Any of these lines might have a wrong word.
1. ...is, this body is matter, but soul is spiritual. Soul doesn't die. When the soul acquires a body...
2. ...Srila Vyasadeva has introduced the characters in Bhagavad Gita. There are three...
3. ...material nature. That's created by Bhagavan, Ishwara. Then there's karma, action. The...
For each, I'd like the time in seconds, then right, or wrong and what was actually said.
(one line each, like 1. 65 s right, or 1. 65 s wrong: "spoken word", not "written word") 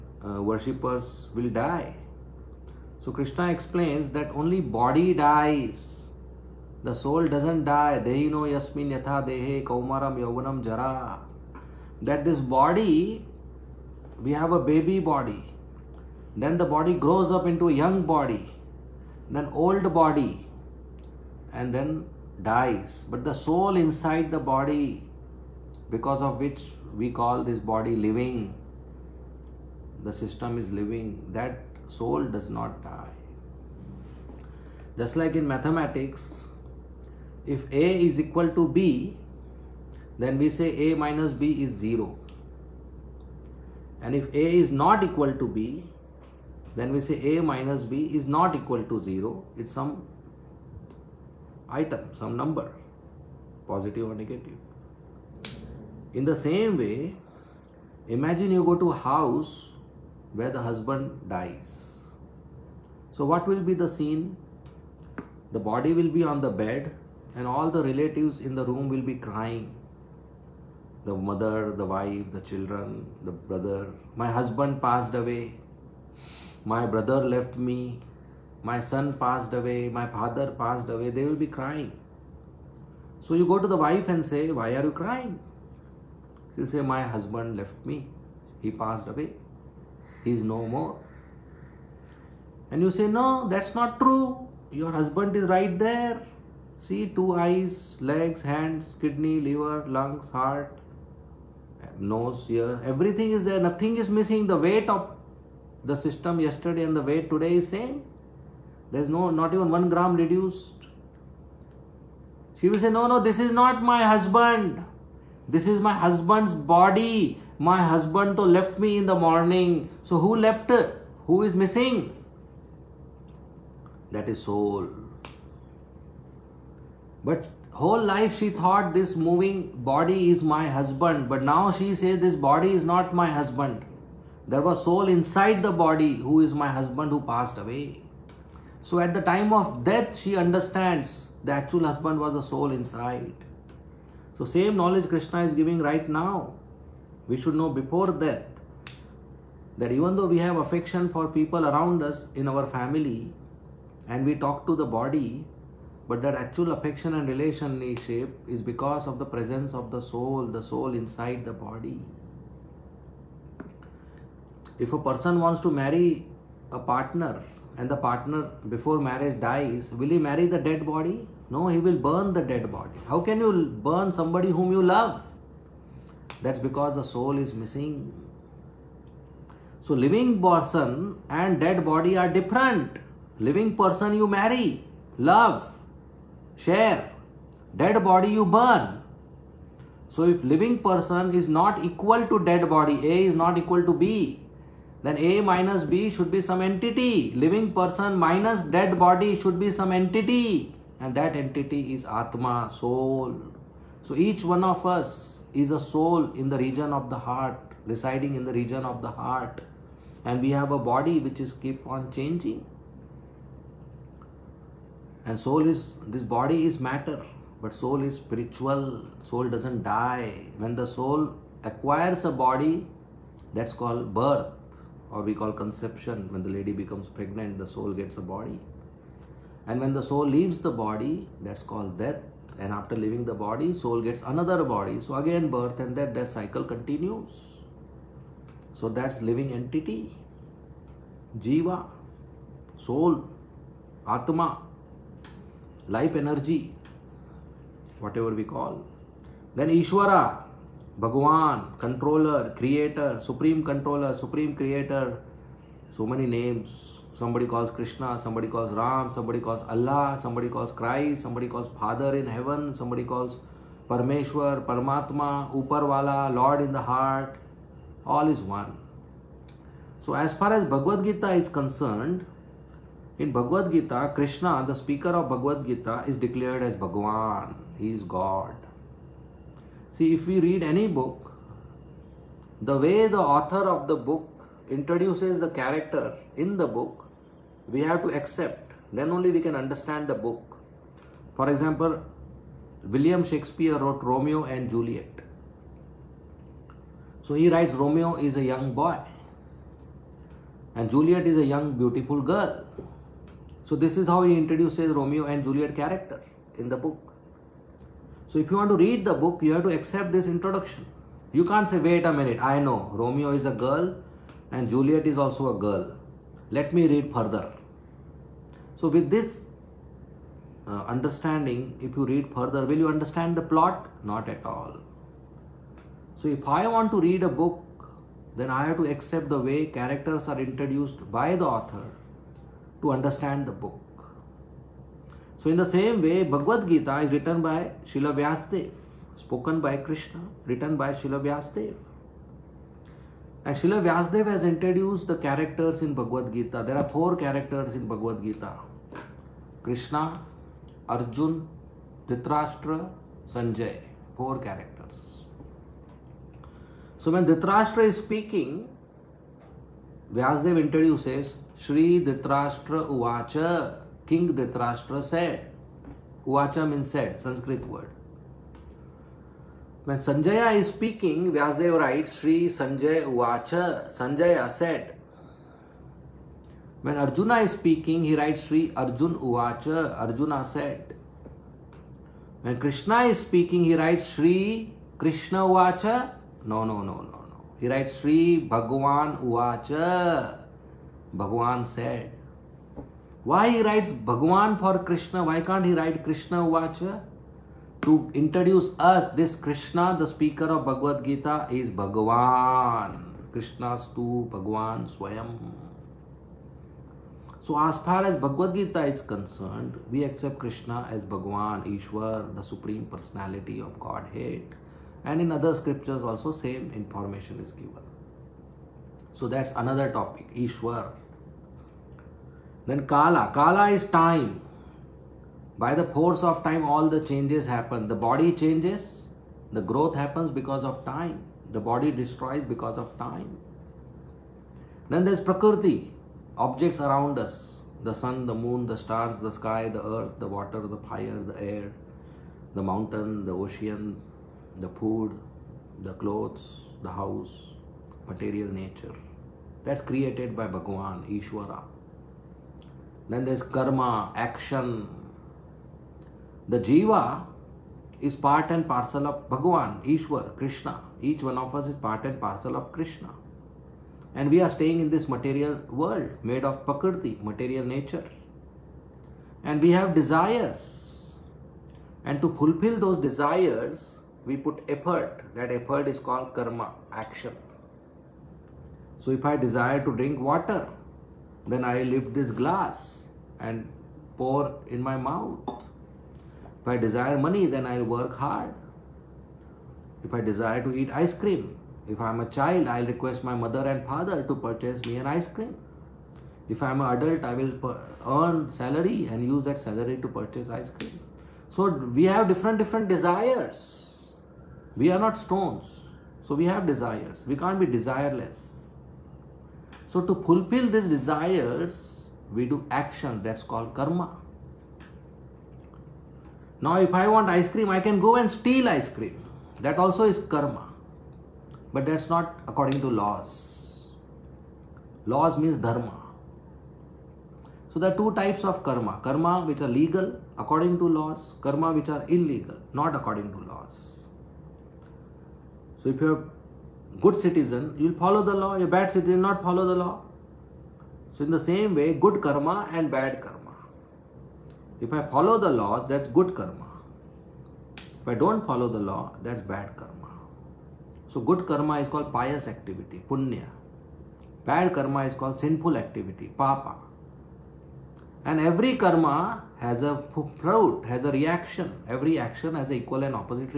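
1. 215 s right
2. 343 s wrong: "four", not "three"
3. 448 s right.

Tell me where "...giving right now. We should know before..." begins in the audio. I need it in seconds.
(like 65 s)
145 s.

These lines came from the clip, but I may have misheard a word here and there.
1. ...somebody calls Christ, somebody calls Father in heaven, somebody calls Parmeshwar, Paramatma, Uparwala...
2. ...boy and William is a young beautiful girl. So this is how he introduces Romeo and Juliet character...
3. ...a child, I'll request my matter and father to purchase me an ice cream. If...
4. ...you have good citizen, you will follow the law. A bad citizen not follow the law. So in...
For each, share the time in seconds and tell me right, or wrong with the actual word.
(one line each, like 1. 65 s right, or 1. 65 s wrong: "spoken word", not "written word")
1. 260 s right
2. 298 s wrong: "Juliet", not "William"
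3. 492 s wrong: "mother", not "matter"
4. 536 s right.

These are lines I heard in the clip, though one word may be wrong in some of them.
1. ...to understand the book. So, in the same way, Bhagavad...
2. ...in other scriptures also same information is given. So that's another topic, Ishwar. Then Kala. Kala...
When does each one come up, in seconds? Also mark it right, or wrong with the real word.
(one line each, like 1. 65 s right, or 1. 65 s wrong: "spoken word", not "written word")
1. 332 s right
2. 415 s right.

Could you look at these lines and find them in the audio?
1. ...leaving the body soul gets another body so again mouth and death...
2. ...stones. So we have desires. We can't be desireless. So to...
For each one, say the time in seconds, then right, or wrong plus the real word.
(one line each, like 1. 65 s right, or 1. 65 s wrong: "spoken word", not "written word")
1. 232 s wrong: "birth", not "mouth"
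2. 505 s right.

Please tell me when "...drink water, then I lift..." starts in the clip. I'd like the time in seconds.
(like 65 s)
479 s.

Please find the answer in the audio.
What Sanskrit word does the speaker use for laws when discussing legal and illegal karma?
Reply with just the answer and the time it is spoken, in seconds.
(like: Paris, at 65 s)
Dharma, at 525 s.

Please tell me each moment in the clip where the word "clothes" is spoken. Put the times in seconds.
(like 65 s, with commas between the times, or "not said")
446 s.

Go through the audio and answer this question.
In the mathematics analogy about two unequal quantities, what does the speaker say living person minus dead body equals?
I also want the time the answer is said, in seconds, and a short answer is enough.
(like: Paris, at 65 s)
Atma, soul, at 202 s.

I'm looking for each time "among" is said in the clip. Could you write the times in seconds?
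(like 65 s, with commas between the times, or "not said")
not said.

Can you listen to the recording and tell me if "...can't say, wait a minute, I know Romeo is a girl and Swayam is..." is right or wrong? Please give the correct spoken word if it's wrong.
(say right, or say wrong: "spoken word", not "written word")
wrong: "Juliet", not "Swayam".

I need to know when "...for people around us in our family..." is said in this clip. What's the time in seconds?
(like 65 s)
151 s.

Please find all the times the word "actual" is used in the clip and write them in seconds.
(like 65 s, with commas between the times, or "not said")
141 s, 156 s.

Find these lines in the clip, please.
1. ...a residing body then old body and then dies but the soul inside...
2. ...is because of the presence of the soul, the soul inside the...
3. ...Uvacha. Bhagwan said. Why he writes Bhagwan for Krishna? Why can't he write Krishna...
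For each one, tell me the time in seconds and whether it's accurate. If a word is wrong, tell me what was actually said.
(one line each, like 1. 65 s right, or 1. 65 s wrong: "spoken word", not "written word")
1. 17 s wrong: "young", not "residing"
2. 158 s right
3. 389 s right.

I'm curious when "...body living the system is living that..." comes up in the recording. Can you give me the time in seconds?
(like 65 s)
27 s.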